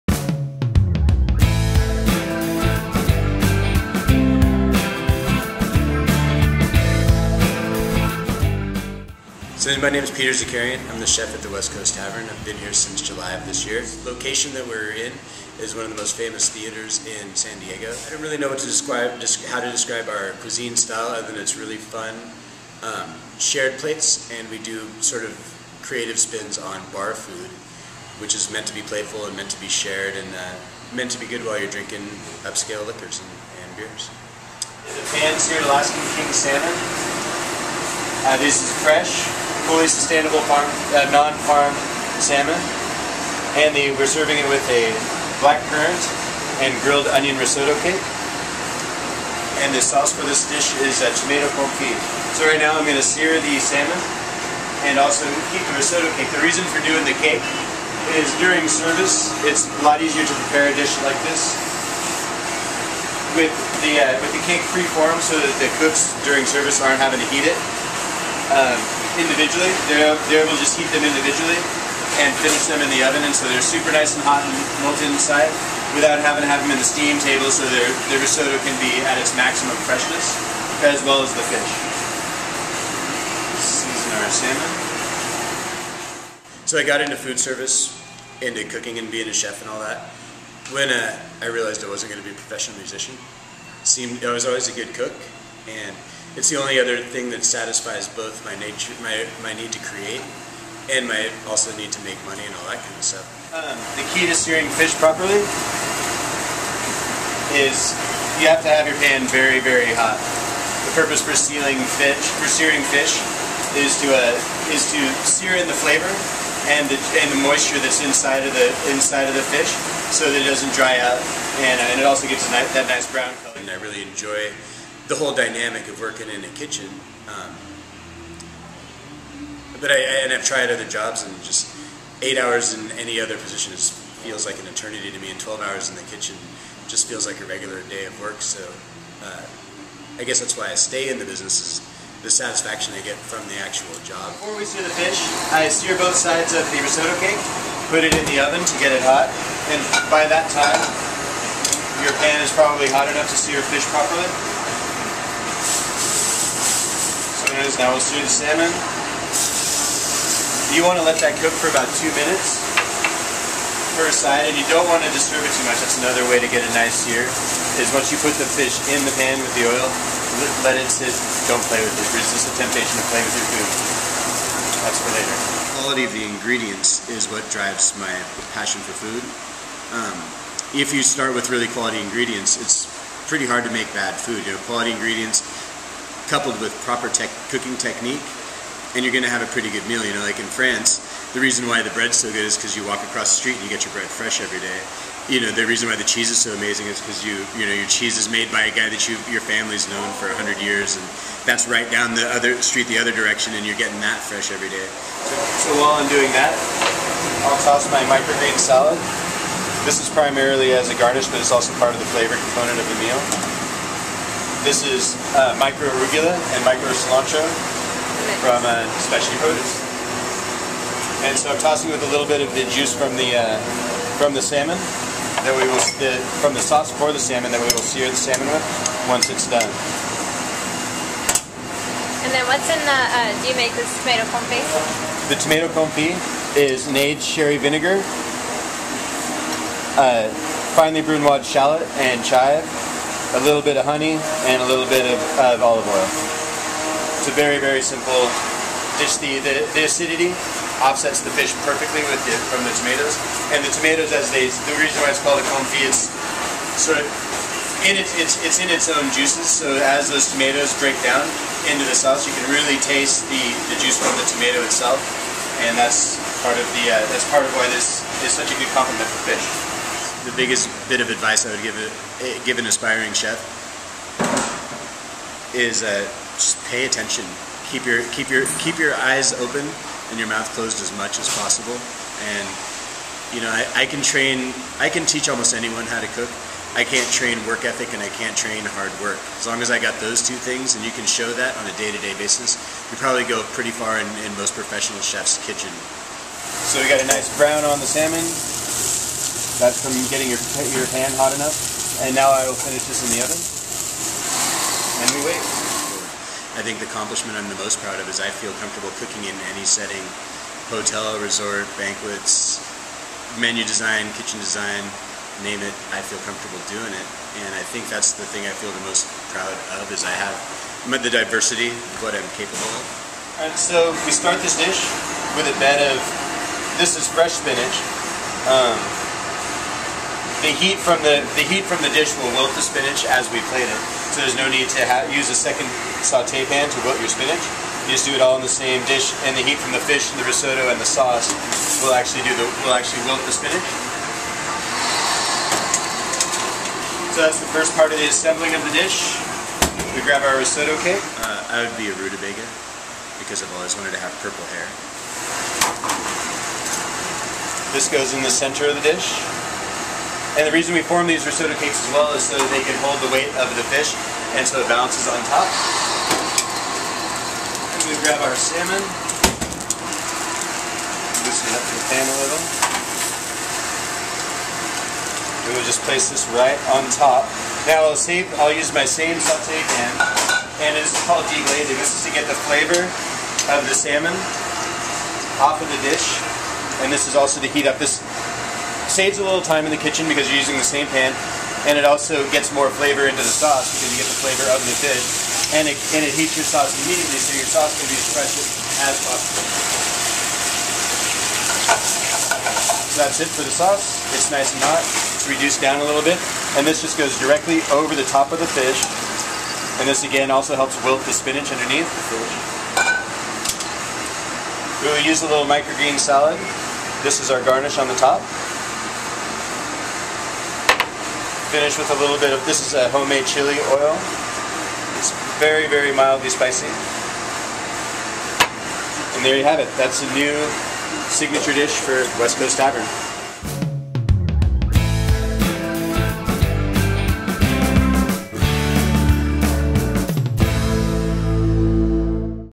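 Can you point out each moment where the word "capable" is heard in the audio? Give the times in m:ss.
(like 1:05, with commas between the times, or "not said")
5:22.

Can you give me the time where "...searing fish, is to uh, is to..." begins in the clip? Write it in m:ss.
1:52.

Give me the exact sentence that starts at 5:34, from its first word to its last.
So there's no need to use a second saute pan to wilt your spinach.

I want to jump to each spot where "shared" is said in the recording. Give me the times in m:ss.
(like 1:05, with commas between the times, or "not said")
0:23, 0:29.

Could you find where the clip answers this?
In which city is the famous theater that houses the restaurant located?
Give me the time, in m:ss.
0:17.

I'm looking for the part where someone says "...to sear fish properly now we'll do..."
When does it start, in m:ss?
2:33.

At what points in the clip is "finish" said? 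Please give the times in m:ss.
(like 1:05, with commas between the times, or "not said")
1:12, 5:02, 7:01.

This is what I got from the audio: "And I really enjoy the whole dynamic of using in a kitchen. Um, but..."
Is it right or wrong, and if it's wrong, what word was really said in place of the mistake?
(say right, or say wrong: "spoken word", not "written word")
wrong: "working", not "using".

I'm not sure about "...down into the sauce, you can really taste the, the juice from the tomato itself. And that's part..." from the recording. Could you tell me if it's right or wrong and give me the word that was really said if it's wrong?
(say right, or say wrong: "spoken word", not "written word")
right.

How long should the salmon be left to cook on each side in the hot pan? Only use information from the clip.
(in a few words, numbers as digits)
about 2 minutes.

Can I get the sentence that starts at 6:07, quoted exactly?
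And we grab our salmon, loosen it up in the pan a little.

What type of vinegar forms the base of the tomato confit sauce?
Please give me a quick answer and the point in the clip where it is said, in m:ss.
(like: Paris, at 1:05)
aged sherry vinegar, at 3:56.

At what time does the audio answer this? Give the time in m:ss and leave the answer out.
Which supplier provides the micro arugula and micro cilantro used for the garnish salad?
3:39.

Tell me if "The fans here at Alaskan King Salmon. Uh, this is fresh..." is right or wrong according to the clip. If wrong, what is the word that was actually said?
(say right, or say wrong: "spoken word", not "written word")
right.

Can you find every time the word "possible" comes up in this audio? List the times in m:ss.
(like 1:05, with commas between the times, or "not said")
4:41, 6:39.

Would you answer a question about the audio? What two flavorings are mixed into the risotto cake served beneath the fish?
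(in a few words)
black currant and grilled onion.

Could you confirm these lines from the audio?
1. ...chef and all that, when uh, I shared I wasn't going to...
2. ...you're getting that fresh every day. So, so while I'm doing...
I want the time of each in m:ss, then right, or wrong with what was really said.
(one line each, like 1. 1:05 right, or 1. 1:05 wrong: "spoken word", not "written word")
1. 1:29 wrong: "realized", not "shared"
2. 3:23 right.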